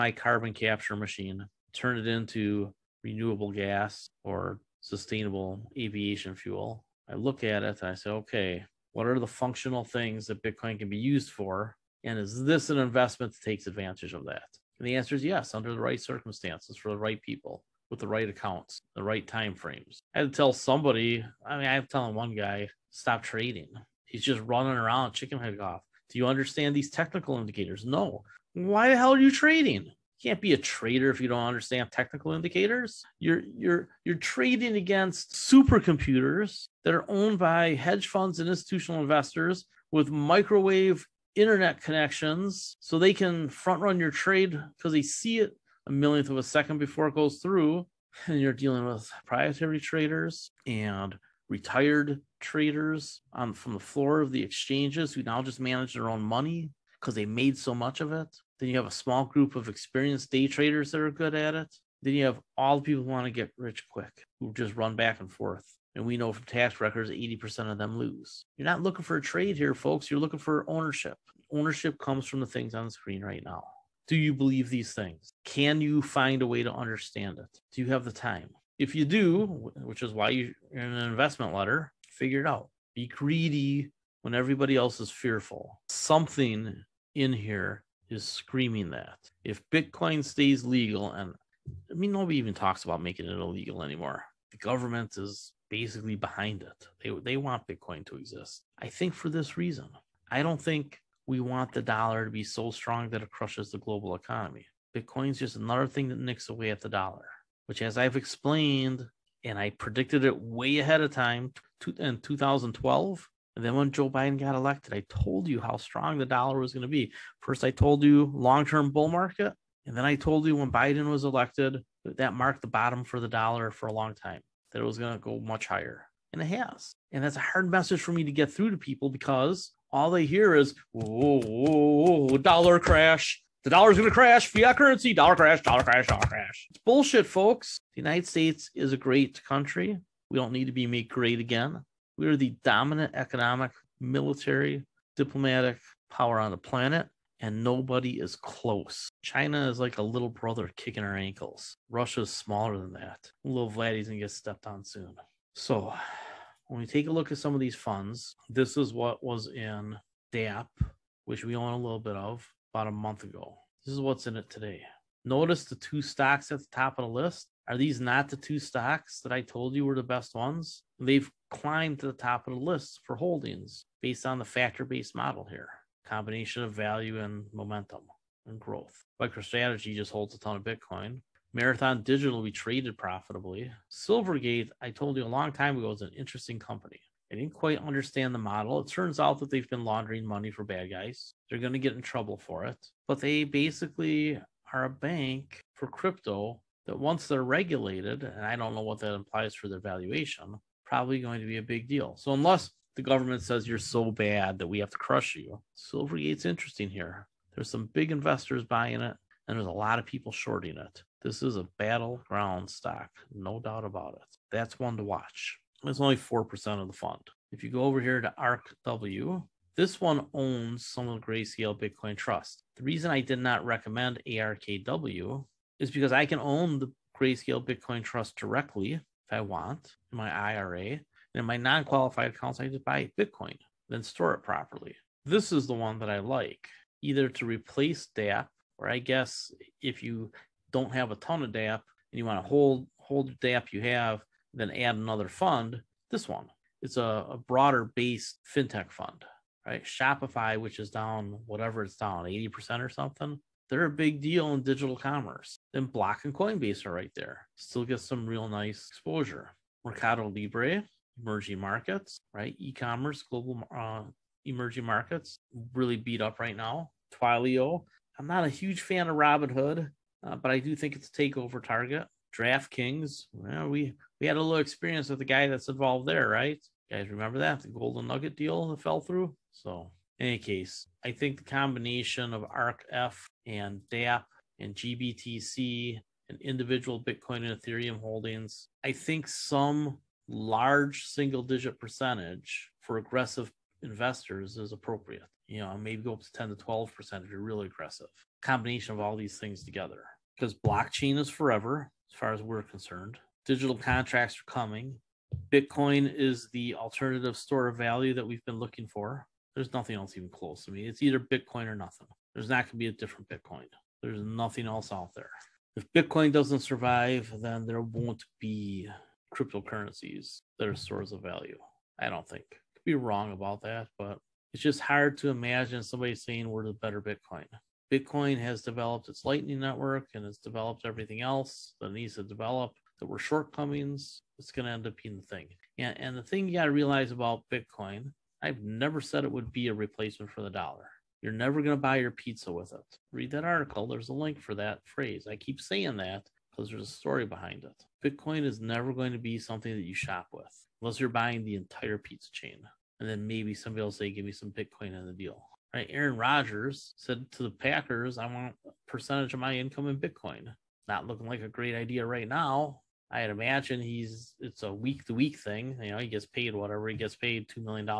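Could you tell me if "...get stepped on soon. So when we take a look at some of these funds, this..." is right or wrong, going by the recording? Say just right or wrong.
right.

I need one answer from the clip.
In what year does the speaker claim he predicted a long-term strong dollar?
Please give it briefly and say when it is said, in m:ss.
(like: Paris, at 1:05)
2012, at 1:52.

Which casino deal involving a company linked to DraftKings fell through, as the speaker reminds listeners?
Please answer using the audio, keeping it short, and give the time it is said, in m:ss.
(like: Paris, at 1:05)
Golden Nugget, at 4:37.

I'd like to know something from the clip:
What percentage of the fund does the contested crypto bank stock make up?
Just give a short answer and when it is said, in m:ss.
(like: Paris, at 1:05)
4%, at 3:36.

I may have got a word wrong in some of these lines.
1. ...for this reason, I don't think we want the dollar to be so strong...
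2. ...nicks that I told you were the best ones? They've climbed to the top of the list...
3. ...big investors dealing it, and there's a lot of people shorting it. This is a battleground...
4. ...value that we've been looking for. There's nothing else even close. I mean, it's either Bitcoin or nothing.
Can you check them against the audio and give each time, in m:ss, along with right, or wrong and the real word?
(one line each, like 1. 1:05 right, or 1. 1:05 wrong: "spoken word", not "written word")
1. 1:39 right
2. 2:48 wrong: "stocks", not "nicks"
3. 3:27 wrong: "buying", not "dealing"
4. 5:07 right.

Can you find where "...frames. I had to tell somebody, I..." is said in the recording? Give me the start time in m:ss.
0:19.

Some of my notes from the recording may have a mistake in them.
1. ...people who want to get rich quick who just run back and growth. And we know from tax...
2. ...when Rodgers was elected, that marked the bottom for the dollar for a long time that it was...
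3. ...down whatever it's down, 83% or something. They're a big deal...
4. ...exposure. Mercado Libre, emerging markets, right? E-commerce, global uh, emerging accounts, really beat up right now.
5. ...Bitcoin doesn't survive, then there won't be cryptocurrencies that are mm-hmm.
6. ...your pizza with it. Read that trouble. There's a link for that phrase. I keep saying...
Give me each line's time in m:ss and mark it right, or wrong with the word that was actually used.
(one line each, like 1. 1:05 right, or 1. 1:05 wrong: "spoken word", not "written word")
1. 1:02 wrong: "forth", not "growth"
2. 2:00 wrong: "Biden", not "Rodgers"
3. 4:10 wrong: "80", not "83"
4. 4:18 wrong: "markets", not "accounts"
5. 5:15 right
6. 5:41 wrong: "article", not "trouble".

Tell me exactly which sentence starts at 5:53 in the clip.
And then maybe somebody will say, give me some Bitcoin in the deal.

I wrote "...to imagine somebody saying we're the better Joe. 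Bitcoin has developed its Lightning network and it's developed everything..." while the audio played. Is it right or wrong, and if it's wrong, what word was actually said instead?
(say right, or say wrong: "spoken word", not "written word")
wrong: "Bitcoin", not "Joe".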